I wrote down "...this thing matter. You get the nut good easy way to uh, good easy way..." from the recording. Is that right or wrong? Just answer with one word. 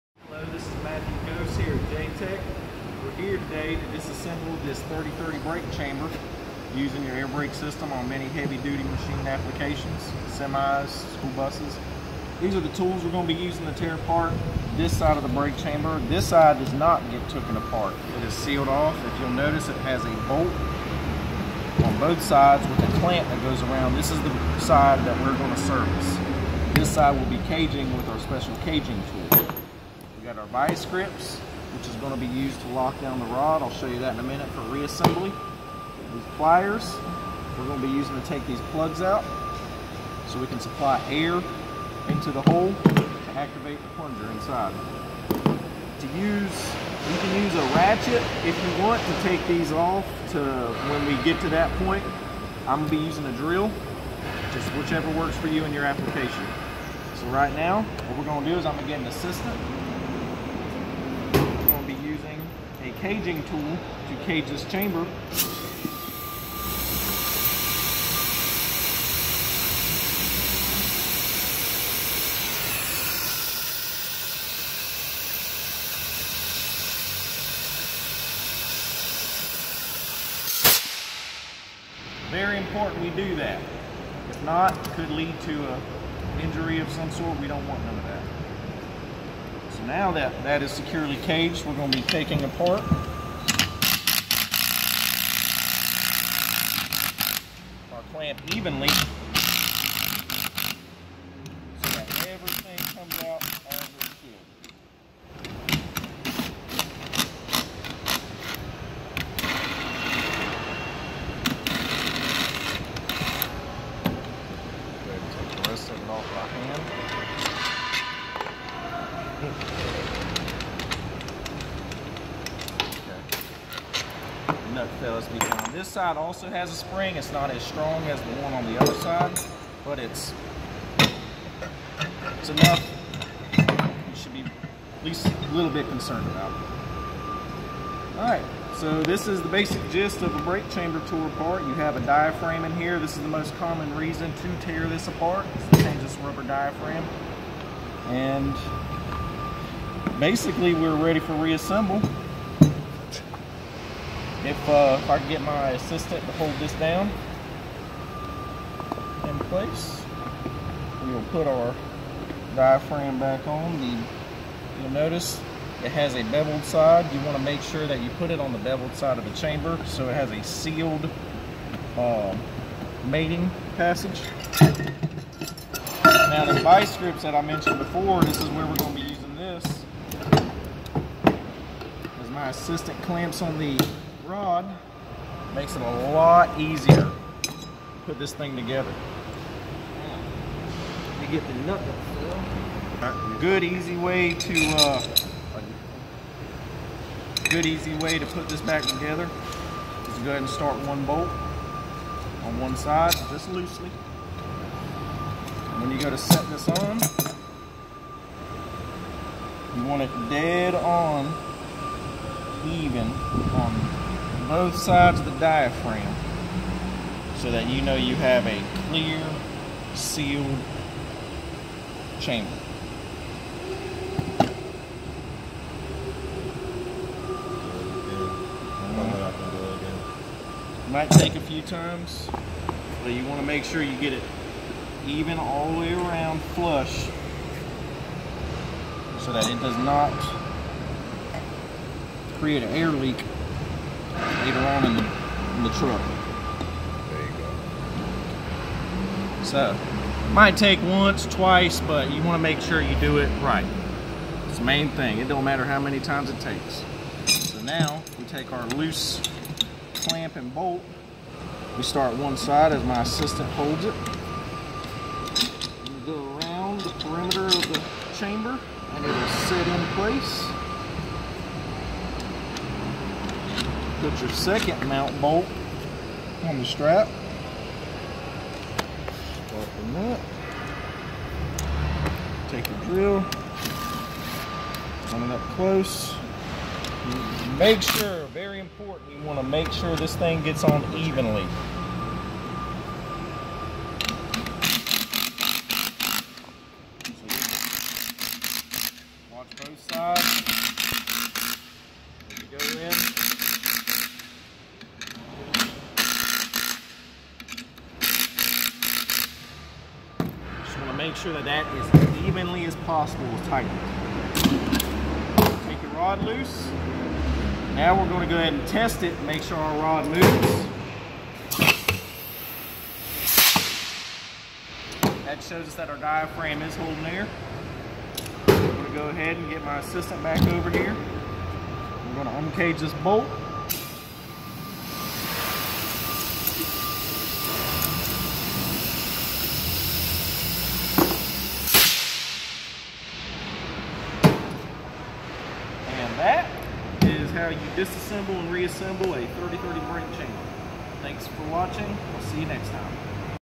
wrong.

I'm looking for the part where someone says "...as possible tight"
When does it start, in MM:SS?
05:12.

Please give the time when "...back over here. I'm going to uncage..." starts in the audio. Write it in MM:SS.
05:30.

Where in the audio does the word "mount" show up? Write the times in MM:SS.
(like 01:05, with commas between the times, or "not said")
04:34.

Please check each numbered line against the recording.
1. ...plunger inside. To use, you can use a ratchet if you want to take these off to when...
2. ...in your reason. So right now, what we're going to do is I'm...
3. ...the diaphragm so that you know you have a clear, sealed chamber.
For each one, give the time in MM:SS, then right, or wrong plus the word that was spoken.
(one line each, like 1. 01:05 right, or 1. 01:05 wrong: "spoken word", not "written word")
1. 00:43 right
2. 00:55 wrong: "application", not "reason"
3. 03:35 right.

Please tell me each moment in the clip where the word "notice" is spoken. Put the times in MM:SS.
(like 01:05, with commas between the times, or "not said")
00:19, 02:44.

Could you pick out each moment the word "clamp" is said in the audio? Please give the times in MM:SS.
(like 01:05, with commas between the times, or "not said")
00:22, 01:38, 03:03, 04:19.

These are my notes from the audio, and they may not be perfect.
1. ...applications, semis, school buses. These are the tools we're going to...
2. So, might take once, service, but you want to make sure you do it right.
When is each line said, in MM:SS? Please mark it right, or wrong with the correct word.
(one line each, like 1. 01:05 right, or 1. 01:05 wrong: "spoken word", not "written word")
1. 00:09 right
2. 04:09 wrong: "twice", not "service".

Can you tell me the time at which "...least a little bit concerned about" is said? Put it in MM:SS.
02:15.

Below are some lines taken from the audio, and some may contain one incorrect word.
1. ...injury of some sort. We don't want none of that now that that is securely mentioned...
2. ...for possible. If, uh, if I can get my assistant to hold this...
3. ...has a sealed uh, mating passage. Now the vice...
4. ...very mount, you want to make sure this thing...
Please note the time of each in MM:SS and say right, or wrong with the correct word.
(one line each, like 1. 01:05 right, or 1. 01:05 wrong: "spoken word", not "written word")
1. 01:26 wrong: "caged", not "mentioned"
2. 02:31 wrong: "reassemble", not "possible"
3. 02:50 right
4. 04:48 wrong: "important", not "mount".